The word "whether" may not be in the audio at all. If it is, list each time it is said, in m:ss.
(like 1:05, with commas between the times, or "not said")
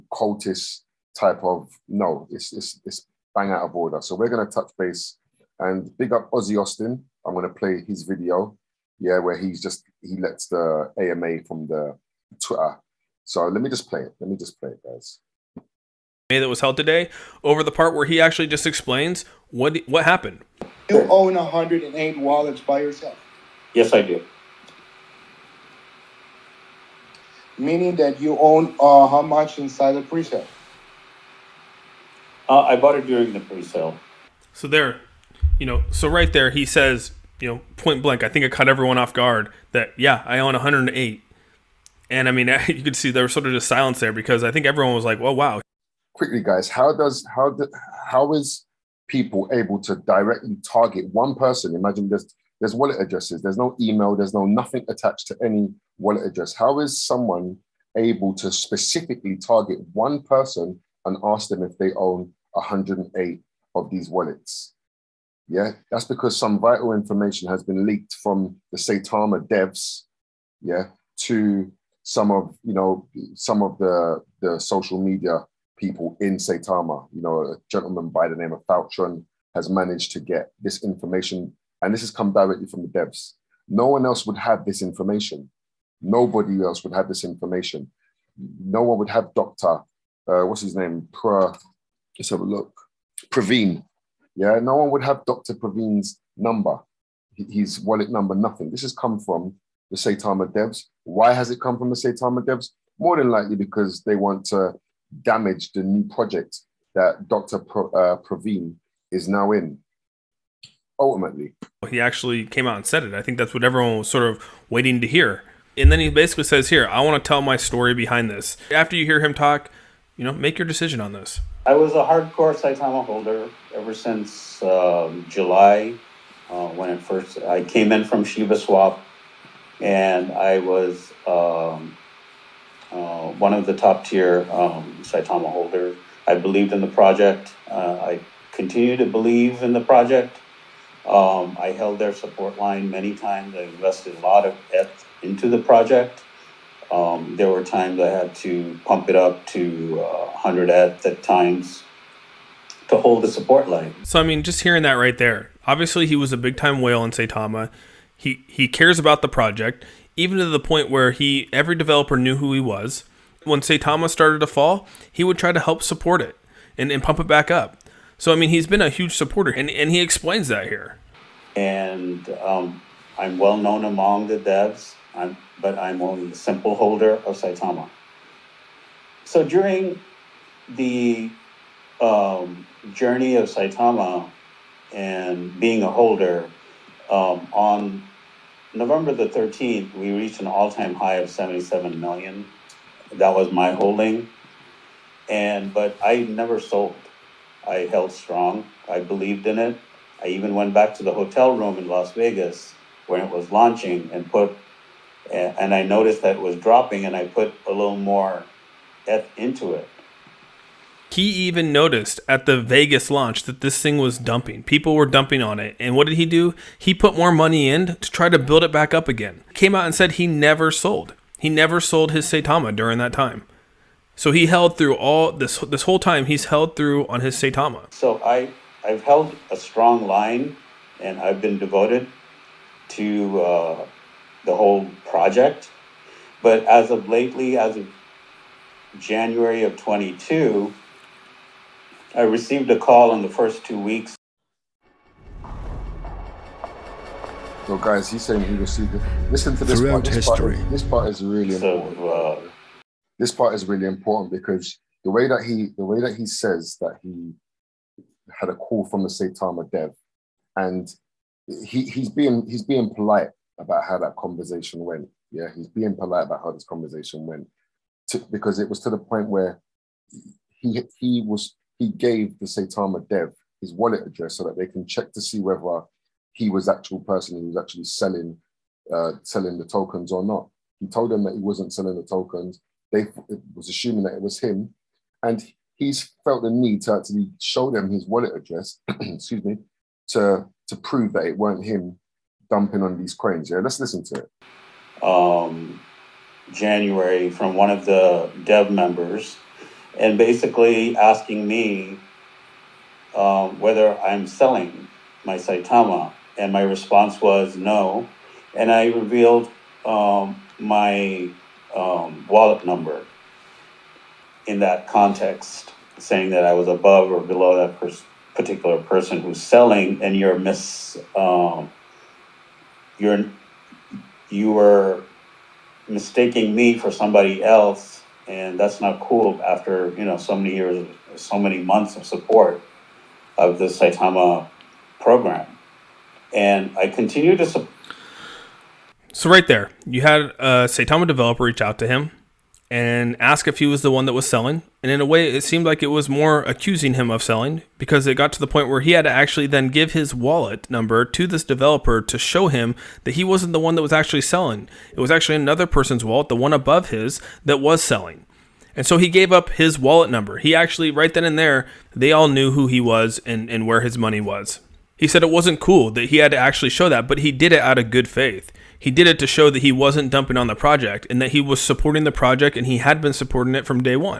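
4:35, 5:03.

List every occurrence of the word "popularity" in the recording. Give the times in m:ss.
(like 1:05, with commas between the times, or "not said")
not said.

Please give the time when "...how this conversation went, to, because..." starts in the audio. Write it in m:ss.
4:26.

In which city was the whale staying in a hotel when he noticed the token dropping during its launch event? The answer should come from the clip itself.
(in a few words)
Las Vegas.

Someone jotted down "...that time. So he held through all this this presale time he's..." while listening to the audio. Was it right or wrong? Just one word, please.
wrong.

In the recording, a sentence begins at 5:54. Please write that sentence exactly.
It was actually another person's wallet, the one above his, that was selling.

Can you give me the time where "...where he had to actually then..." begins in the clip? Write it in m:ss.
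5:48.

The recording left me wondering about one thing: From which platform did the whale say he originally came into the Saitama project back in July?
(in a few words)
Shiba Swap.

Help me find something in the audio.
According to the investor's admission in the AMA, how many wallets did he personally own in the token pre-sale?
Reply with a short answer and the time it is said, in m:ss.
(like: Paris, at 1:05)
108, at 0:21.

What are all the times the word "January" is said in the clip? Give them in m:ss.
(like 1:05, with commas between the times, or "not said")
3:58, 4:56.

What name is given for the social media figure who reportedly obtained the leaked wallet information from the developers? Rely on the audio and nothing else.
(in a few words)
Faltron.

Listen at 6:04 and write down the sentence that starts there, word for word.
He said it wasn't cool that he had to actually show that, but he did it out of good faith.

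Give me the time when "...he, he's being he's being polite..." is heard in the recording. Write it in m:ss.
4:21.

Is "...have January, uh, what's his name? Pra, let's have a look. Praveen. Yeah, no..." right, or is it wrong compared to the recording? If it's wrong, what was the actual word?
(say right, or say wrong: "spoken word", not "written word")
wrong: "Doctor", not "January".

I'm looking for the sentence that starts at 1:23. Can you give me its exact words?
No one else would have this information.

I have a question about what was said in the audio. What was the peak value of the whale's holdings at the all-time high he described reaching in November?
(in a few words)
77 million.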